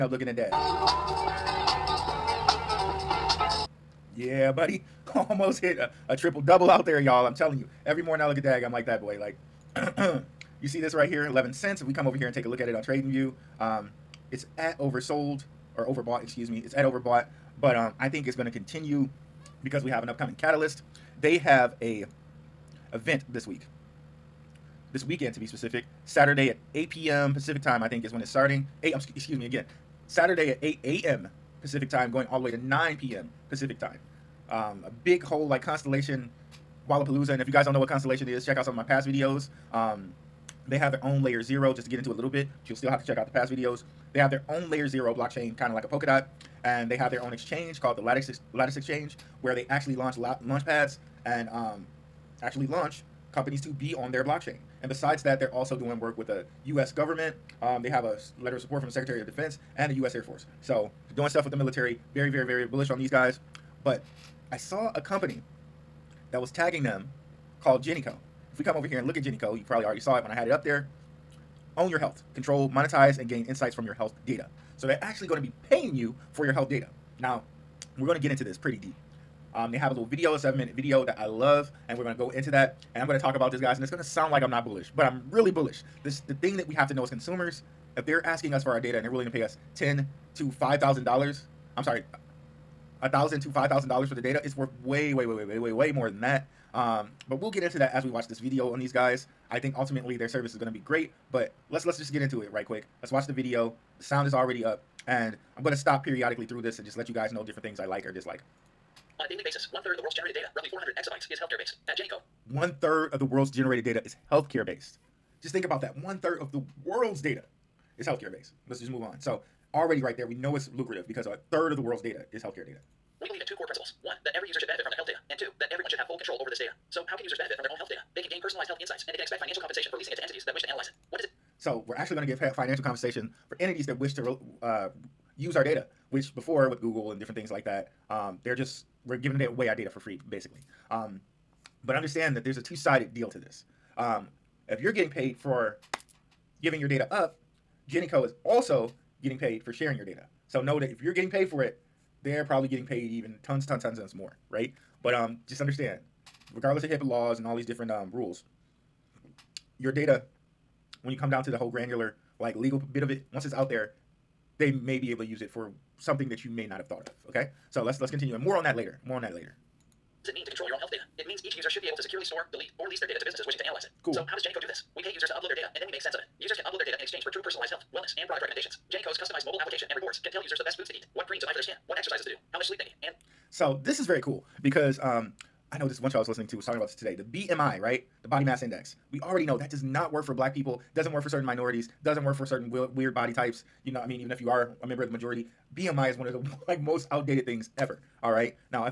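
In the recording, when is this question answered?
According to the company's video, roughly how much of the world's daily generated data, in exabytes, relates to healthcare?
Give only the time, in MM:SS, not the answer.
01:50.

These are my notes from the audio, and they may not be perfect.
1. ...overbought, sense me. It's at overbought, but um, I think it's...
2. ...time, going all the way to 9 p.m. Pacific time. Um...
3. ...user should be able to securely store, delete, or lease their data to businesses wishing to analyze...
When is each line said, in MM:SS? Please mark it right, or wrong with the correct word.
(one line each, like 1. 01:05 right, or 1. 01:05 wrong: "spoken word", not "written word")
1. 00:15 wrong: "excuse", not "sense"
2. 00:31 right
3. 02:51 right.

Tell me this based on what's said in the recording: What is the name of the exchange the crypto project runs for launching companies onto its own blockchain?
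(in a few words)
Lattice Exchange.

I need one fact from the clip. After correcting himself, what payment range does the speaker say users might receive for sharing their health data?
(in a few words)
$1,000 to $5,000.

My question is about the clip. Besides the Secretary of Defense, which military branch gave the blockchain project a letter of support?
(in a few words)
U.S. Air Force.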